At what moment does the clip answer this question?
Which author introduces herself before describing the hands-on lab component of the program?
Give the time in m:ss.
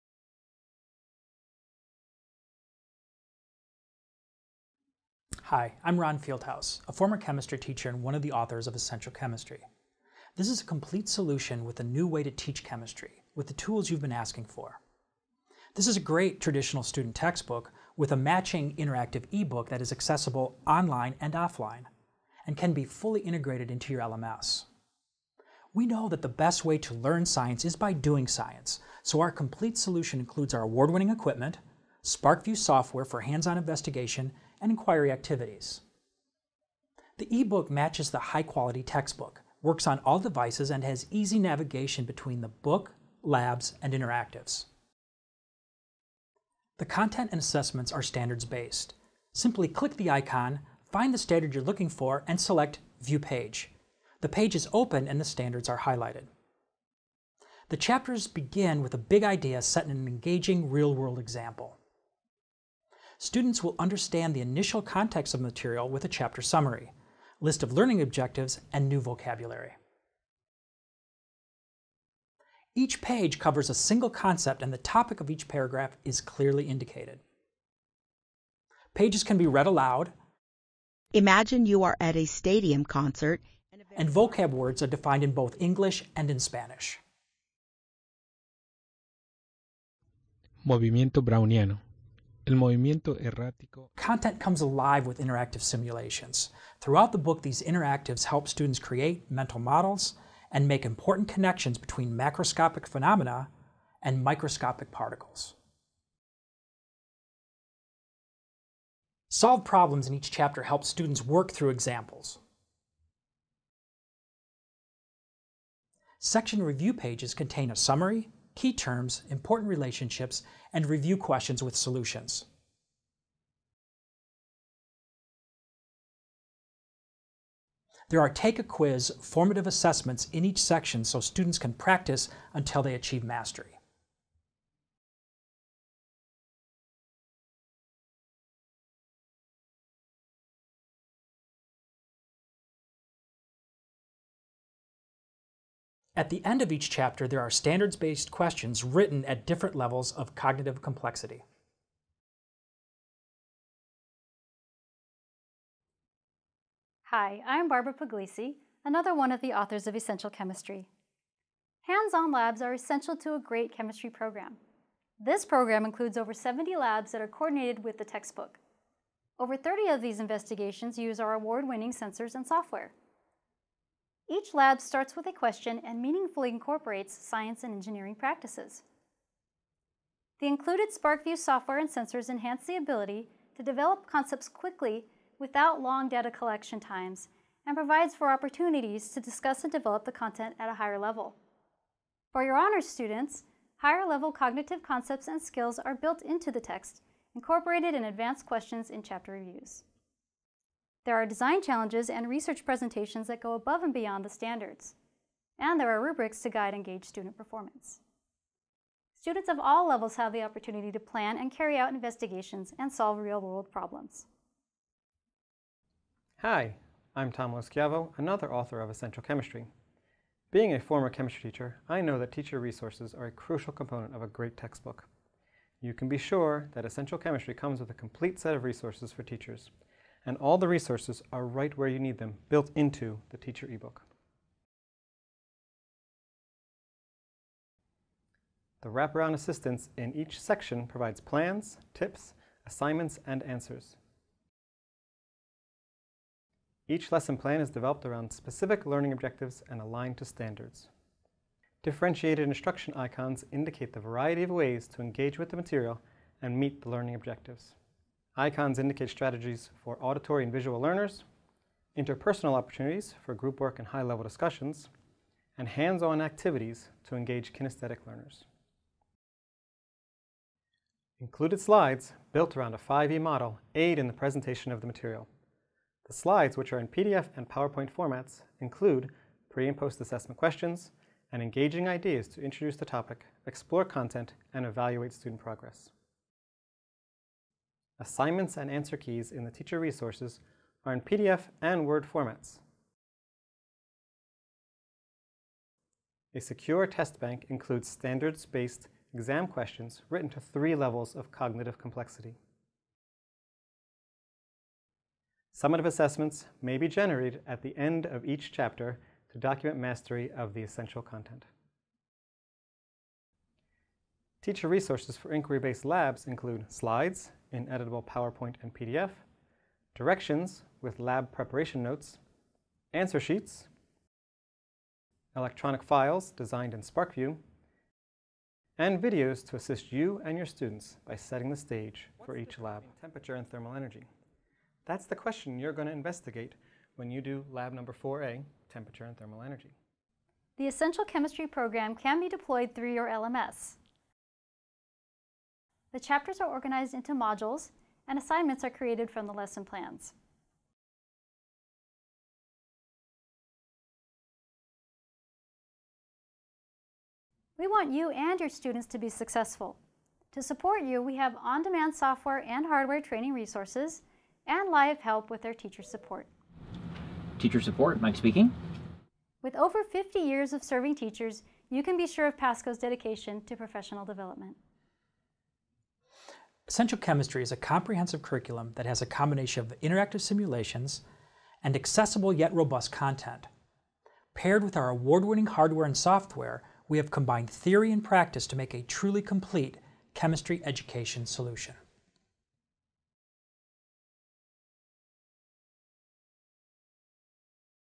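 2:37.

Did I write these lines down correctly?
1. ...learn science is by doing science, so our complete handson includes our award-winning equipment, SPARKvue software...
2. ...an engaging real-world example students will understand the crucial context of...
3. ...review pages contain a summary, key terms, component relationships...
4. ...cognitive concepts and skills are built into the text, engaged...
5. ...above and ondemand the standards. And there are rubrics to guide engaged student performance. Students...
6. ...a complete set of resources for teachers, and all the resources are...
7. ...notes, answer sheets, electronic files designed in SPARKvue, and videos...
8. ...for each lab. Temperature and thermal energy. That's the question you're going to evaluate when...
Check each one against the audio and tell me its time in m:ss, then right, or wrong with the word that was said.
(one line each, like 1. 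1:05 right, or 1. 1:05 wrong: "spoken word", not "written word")
1. 0:26 wrong: "solution", not "handson"
2. 0:59 wrong: "initial", not "crucial"
3. 1:56 wrong: "important", not "component"
4. 3:14 wrong: "incorporated", not "engaged"
5. 3:23 wrong: "beyond", not "ondemand"
6. 3:47 right
7. 5:21 right
8. 5:32 wrong: "investigate", not "evaluate".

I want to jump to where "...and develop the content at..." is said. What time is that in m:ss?
3:09.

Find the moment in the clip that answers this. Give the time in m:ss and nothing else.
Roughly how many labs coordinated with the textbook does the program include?
2:46.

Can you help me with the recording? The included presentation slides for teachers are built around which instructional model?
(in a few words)
5E model.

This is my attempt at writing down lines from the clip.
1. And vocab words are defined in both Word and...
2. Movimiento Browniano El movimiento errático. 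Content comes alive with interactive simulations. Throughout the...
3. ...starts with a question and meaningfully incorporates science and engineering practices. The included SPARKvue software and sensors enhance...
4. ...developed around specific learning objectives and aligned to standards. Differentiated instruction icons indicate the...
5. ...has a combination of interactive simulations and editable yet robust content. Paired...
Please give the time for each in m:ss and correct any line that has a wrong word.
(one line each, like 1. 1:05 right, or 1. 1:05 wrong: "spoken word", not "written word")
1. 1:23 wrong: "English", not "Word"
2. 1:30 right
3. 2:54 right
4. 4:07 right
5. 6:18 wrong: "accessible", not "editable".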